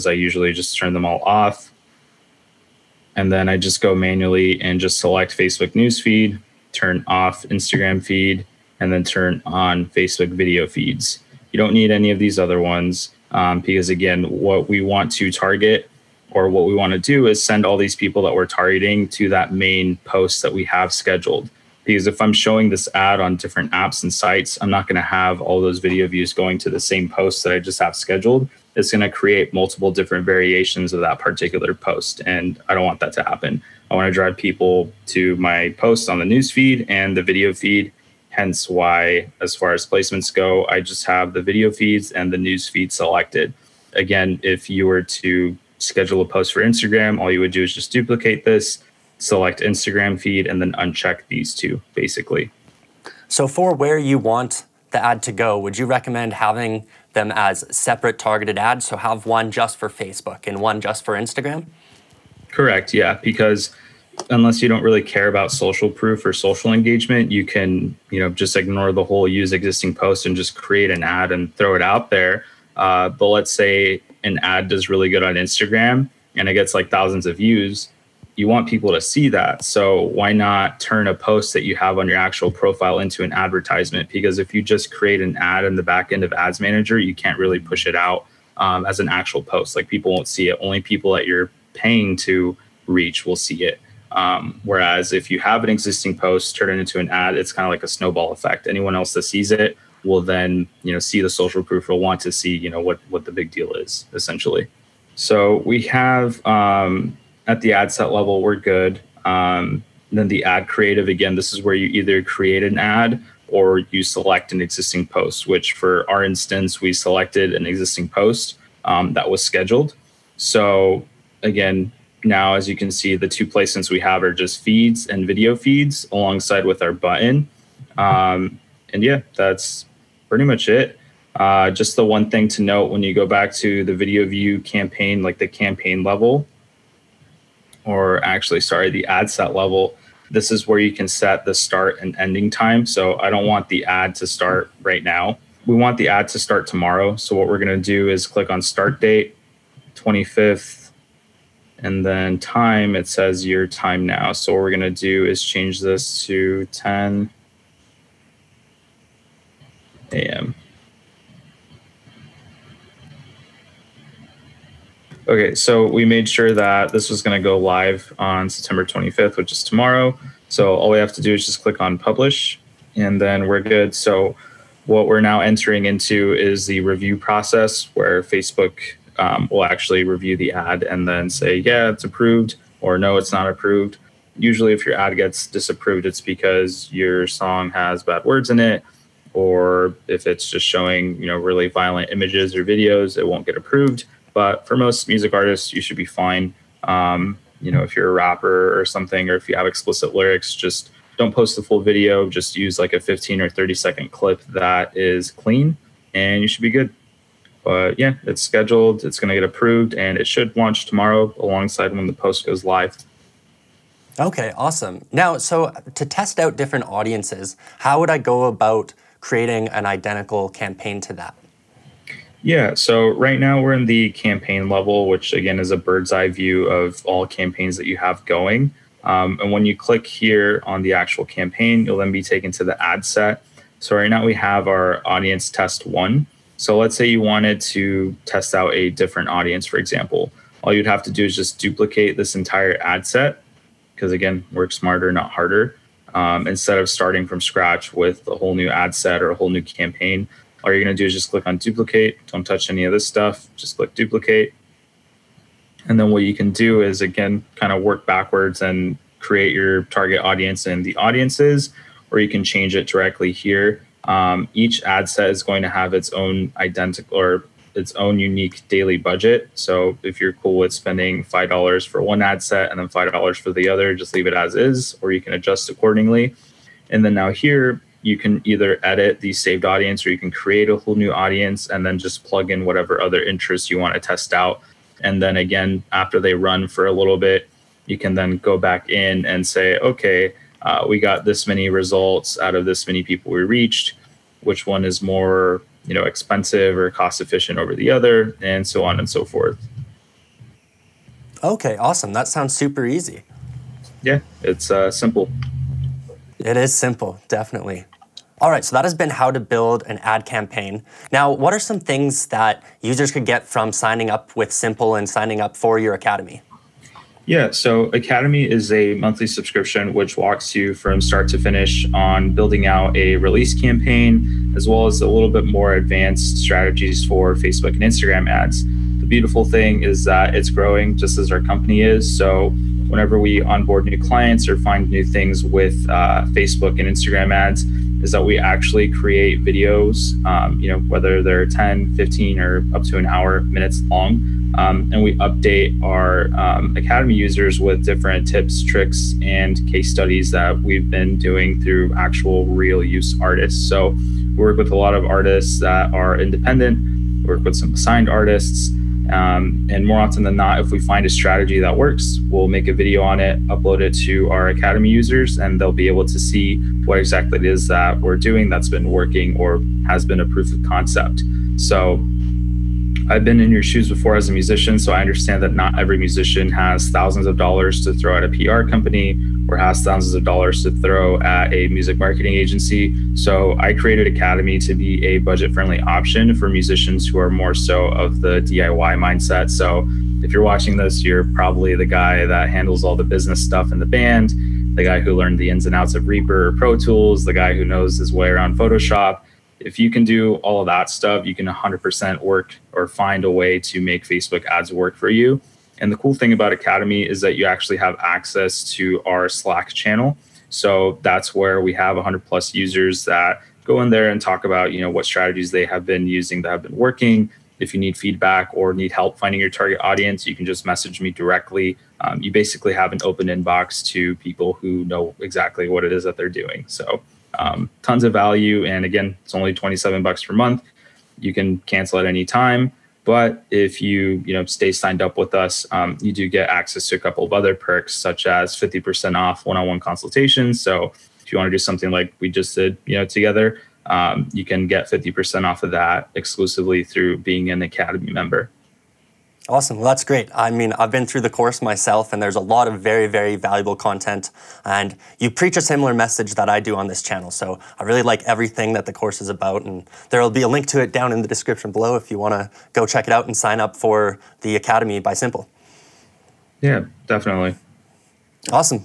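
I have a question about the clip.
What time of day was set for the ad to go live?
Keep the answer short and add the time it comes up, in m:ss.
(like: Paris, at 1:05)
10 a.m., at 2:36.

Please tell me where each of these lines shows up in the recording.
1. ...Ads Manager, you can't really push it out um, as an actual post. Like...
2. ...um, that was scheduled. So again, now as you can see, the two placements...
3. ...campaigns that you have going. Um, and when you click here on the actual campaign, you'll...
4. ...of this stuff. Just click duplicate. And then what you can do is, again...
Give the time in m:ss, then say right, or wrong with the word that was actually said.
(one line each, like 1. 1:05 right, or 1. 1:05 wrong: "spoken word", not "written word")
1. 1:26 right
2. 1:58 right
3. 3:47 right
4. 4:12 right.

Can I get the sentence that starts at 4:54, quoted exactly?
Which one is more, you know, expensive or cost efficient over the other, and so on and so forth.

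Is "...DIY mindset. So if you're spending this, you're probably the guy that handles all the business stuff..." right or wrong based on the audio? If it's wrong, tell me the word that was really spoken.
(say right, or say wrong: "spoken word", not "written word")
wrong: "watching", not "spending".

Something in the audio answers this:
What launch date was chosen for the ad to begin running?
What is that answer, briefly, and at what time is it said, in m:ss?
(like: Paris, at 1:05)
September 25th, at 2:48.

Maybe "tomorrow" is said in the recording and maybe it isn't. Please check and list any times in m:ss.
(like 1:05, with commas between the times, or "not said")
2:26, 2:49, 3:30.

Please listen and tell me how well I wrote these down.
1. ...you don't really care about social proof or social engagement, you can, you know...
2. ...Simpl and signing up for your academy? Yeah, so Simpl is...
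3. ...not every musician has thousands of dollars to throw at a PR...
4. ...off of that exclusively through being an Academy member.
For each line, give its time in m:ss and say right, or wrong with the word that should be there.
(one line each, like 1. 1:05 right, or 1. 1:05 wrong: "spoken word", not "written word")
1. 1:04 right
2. 5:14 wrong: "Academy", not "Simpl"
3. 6:15 right
4. 7:25 right.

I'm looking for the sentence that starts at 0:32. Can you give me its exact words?
And I don't want that to happen.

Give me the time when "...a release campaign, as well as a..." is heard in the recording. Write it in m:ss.
5:22.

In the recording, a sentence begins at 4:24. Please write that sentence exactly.
Um, each ad set is going to have its own identical or its own unique daily budget.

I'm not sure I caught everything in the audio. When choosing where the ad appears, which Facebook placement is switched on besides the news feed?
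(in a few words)
Facebook video feeds.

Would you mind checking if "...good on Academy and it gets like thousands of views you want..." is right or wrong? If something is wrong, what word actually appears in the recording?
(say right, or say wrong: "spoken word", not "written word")
wrong: "Instagram", not "Academy".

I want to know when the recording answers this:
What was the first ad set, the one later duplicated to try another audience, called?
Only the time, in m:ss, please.
3:55.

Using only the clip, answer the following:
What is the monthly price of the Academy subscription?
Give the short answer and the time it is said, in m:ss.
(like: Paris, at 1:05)
27 dollars, at 7:09.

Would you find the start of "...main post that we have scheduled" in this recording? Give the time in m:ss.
0:19.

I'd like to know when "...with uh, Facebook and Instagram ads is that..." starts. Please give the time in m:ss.
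5:35.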